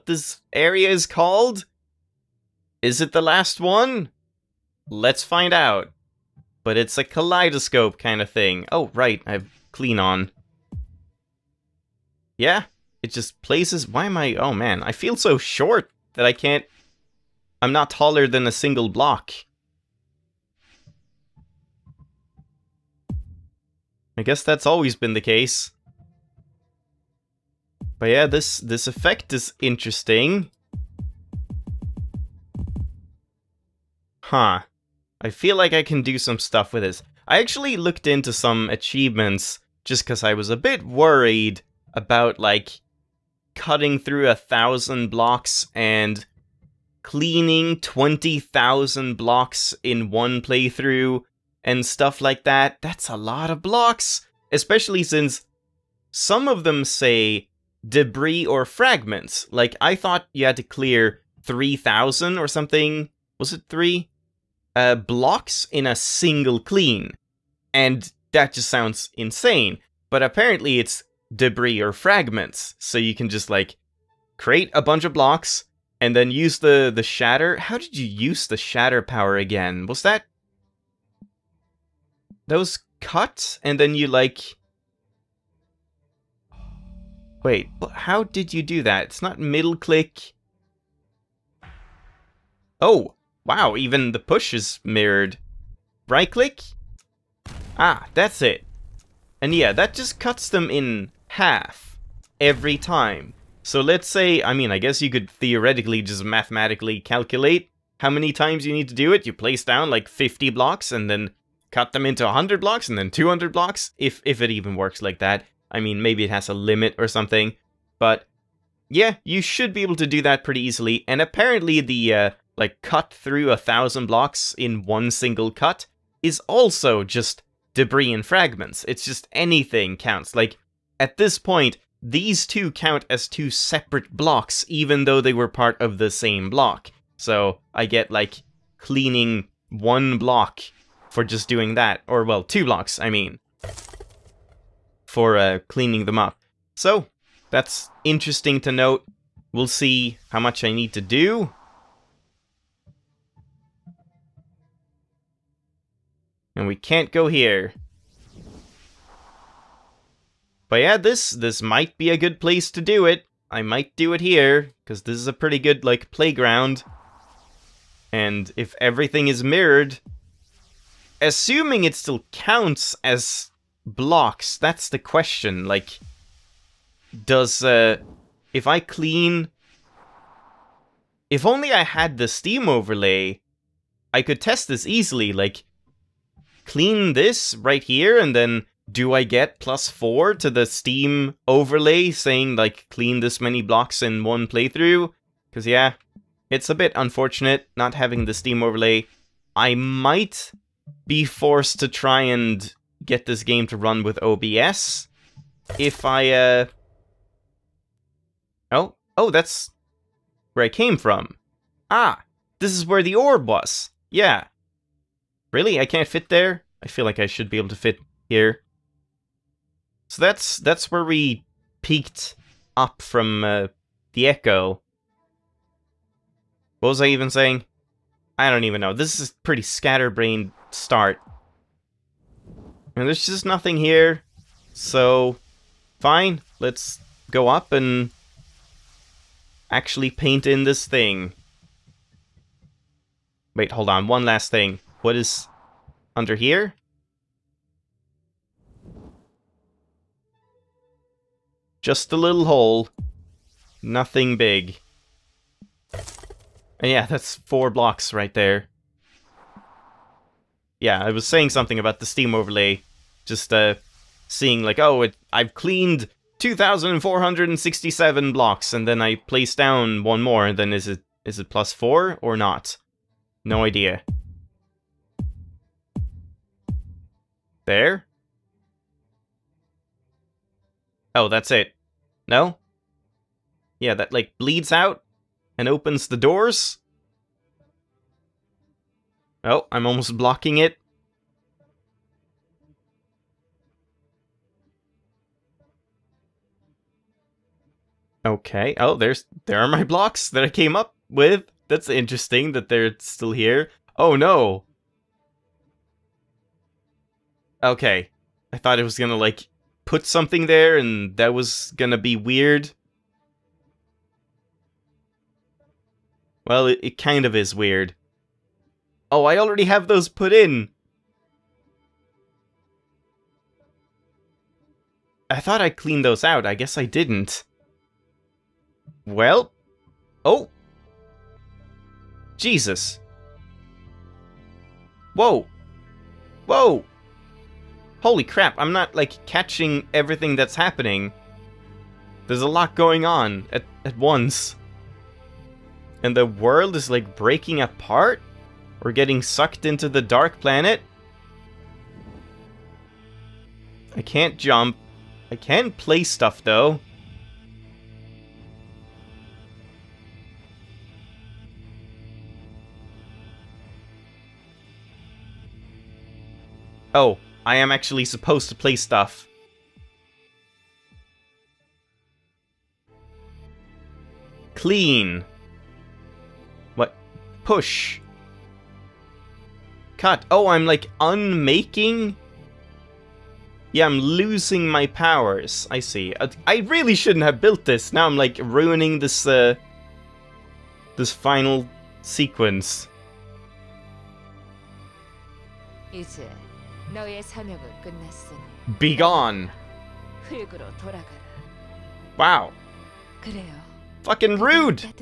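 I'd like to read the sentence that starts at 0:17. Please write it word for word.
I'm not taller than a single block.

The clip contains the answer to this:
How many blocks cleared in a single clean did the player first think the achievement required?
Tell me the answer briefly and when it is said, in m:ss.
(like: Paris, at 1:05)
3,000, at 1:01.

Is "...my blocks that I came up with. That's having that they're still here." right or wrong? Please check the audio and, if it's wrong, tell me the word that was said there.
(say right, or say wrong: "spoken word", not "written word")
wrong: "interesting", not "having".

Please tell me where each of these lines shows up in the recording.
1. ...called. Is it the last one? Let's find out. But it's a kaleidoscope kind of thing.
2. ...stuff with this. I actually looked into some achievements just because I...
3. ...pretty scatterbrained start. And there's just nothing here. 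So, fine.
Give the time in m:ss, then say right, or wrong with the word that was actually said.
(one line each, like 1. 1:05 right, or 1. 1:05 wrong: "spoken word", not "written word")
1. 0:01 right
2. 0:36 right
3. 3:49 right.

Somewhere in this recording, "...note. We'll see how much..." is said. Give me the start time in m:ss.
2:28.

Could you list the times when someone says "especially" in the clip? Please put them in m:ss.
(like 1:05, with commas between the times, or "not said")
0:54.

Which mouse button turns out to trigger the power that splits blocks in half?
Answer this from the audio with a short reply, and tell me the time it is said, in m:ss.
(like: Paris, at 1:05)
Right click, at 1:36.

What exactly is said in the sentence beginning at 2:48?
And if everything is mirrored, assuming it still counts as blocks, that's the question.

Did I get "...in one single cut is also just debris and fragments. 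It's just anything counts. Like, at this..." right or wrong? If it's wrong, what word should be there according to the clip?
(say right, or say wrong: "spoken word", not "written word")
right.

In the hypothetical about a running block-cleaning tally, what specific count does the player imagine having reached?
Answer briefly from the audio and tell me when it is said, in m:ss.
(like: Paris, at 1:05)
2,467, at 4:26.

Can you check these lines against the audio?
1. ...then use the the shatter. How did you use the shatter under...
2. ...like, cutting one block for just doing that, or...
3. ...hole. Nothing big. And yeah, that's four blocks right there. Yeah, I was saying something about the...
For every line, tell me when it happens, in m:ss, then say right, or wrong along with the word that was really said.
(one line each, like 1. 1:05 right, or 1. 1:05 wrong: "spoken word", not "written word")
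1. 1:16 wrong: "power", not "under"
2. 2:18 wrong: "cleaning", not "cutting"
3. 4:12 right.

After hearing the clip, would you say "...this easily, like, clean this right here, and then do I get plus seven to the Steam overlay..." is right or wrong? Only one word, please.
wrong.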